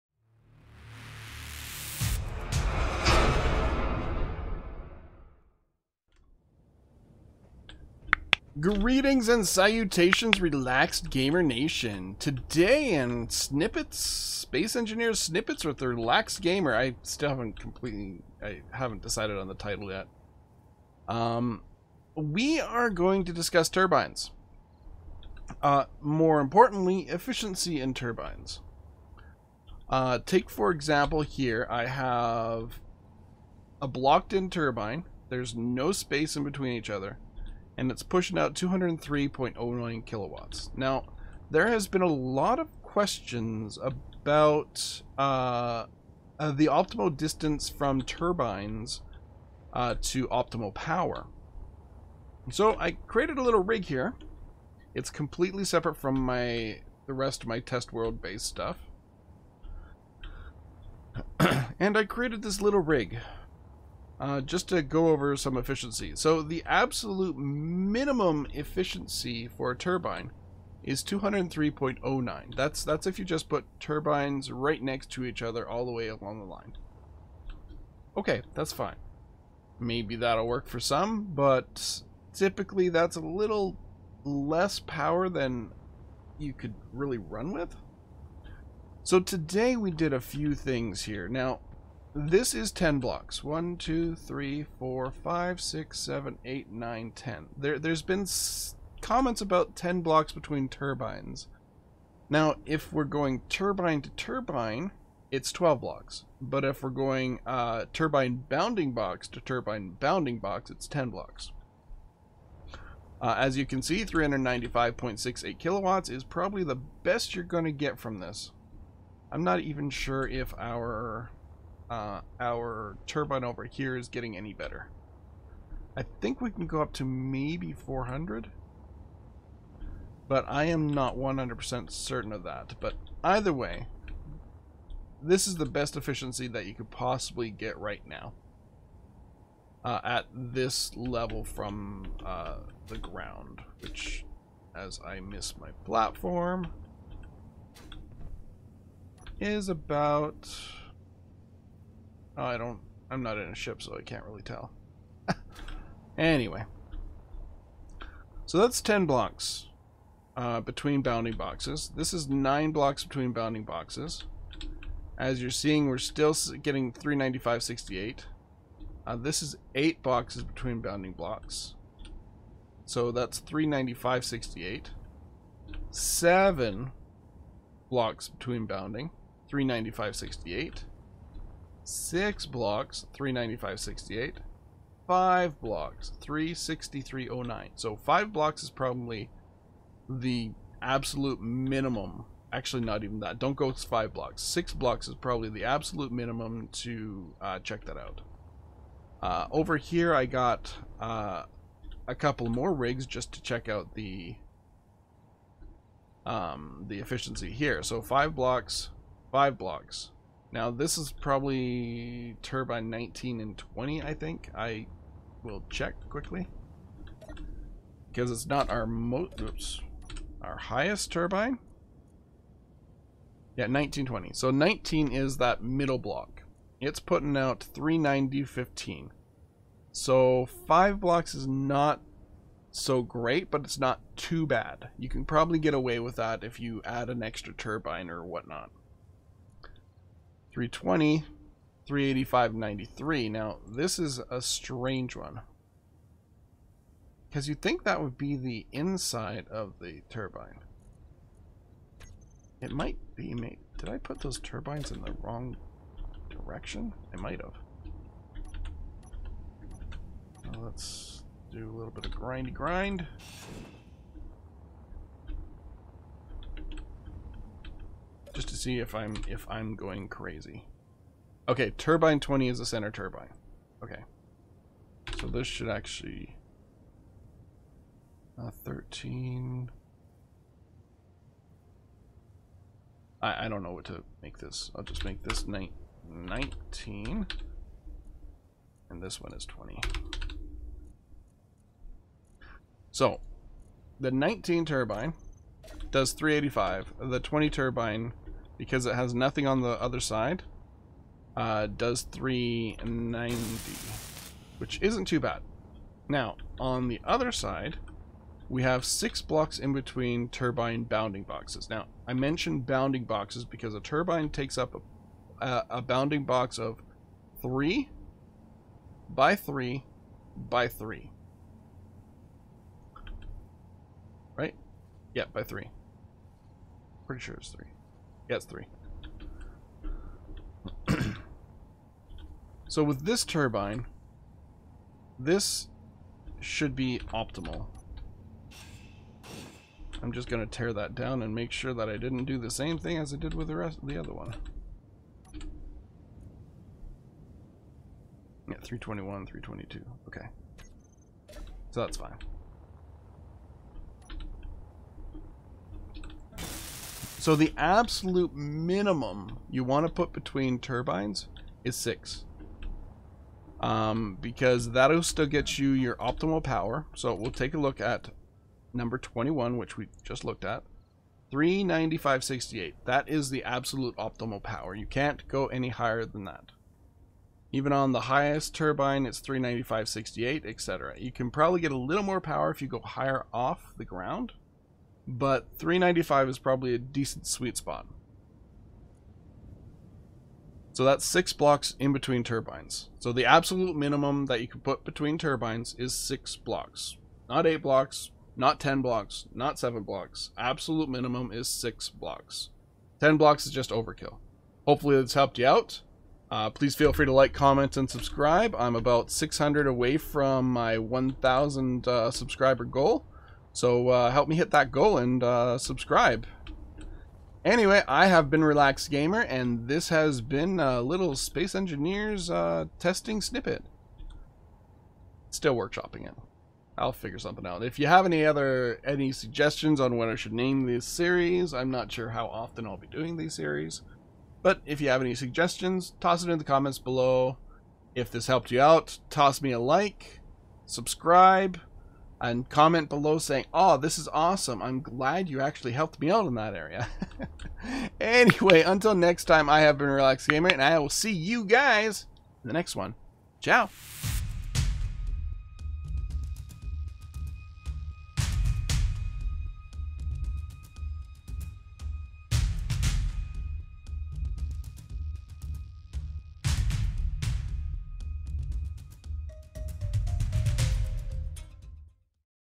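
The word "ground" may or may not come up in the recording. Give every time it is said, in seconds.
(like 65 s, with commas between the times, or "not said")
142 s, 383 s.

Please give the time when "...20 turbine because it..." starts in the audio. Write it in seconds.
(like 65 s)
297 s.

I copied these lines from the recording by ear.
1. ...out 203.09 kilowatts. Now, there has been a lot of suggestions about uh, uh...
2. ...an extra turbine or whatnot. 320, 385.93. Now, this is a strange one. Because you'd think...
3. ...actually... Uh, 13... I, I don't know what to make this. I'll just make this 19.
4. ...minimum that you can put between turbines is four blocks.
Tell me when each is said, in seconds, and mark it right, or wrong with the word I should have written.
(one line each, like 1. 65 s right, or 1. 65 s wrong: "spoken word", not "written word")
1. 38 s wrong: "questions", not "suggestions"
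2. 237 s right
3. 275 s right
4. 393 s wrong: "six", not "four".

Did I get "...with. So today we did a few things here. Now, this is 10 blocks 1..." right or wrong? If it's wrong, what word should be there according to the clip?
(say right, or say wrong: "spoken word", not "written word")
right.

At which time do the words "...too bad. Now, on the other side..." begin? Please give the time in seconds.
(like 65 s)
305 s.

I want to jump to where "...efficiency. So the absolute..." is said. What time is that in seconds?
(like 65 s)
65 s.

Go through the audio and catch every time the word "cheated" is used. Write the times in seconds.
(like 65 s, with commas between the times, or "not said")
not said.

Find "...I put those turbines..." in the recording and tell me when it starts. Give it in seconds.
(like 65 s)
253 s.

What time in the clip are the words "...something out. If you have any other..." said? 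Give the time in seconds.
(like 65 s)
427 s.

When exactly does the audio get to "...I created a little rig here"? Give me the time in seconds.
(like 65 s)
52 s.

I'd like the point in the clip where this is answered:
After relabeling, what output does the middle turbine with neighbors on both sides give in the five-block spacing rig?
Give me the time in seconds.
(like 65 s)
293 s.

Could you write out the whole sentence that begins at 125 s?
I think we can go up to maybe 400.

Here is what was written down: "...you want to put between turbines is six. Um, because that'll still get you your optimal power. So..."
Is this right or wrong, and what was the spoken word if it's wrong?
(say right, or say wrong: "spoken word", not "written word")
right.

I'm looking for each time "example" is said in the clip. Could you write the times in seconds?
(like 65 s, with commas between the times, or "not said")
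30 s.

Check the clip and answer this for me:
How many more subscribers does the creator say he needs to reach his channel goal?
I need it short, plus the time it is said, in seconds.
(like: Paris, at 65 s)
600, at 408 s.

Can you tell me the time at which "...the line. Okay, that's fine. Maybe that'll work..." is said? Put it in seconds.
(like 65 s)
76 s.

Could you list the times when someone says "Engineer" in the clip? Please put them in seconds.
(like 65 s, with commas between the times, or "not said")
14 s, 421 s.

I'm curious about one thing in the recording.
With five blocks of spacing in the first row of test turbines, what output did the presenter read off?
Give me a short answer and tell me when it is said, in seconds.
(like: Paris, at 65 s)
363.09, at 186 s.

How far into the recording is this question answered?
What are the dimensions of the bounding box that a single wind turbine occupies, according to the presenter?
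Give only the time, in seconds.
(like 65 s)
317 s.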